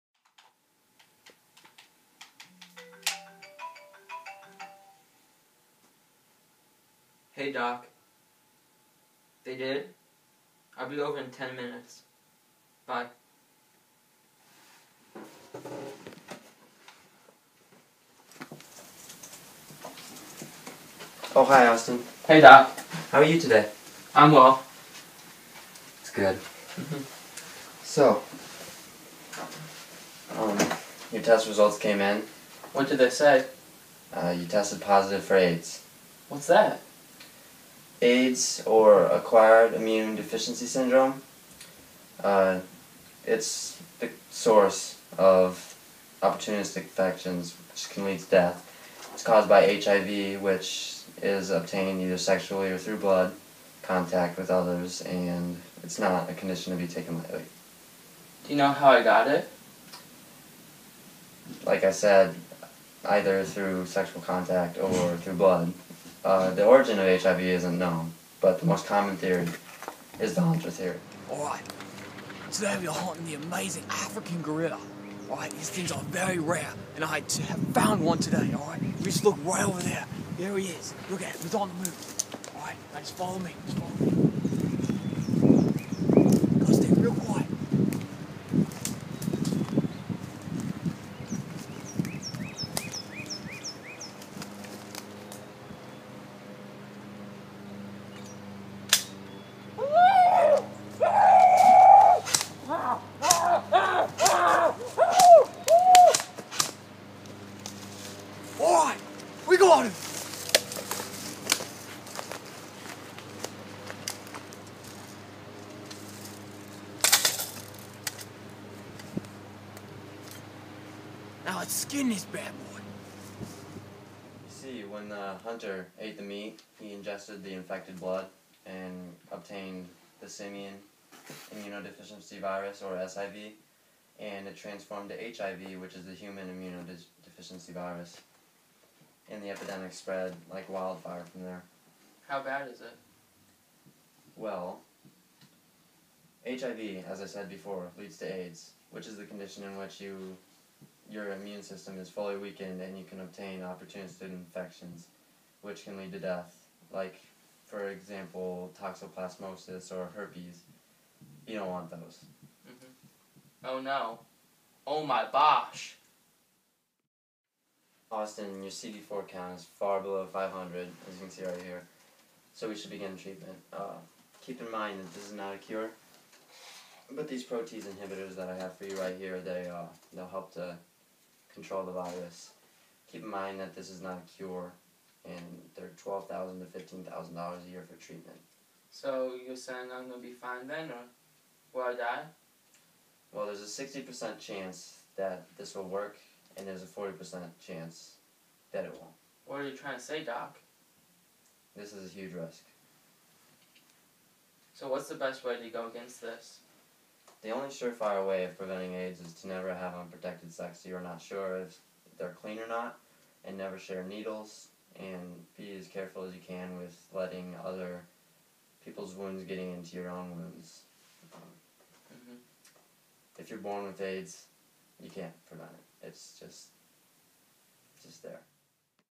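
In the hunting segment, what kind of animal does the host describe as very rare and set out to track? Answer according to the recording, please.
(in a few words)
African gorilla.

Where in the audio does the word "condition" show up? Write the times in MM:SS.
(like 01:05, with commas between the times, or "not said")
00:56, 02:29.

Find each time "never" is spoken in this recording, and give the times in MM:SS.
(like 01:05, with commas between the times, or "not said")
03:29, 03:33.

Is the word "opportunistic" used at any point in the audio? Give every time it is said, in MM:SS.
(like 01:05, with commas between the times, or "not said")
00:46, 02:33.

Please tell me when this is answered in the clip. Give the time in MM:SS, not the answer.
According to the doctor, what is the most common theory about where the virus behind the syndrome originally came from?
01:10.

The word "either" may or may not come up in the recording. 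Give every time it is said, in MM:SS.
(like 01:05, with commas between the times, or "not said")
00:52, 01:03.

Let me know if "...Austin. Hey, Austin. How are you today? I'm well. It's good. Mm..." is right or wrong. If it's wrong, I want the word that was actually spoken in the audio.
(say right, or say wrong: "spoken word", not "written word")
wrong: "Doc", not "Austin".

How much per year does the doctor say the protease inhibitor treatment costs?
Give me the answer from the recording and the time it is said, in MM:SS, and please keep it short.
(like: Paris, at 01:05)
$12,000 to $15,000, at 03:06.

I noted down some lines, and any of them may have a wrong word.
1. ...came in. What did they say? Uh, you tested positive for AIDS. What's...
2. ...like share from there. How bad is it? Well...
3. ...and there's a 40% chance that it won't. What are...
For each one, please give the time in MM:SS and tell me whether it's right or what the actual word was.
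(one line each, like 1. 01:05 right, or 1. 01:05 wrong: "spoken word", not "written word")
1. 00:31 right
2. 02:20 wrong: "wildfire", not "share"
3. 03:16 right.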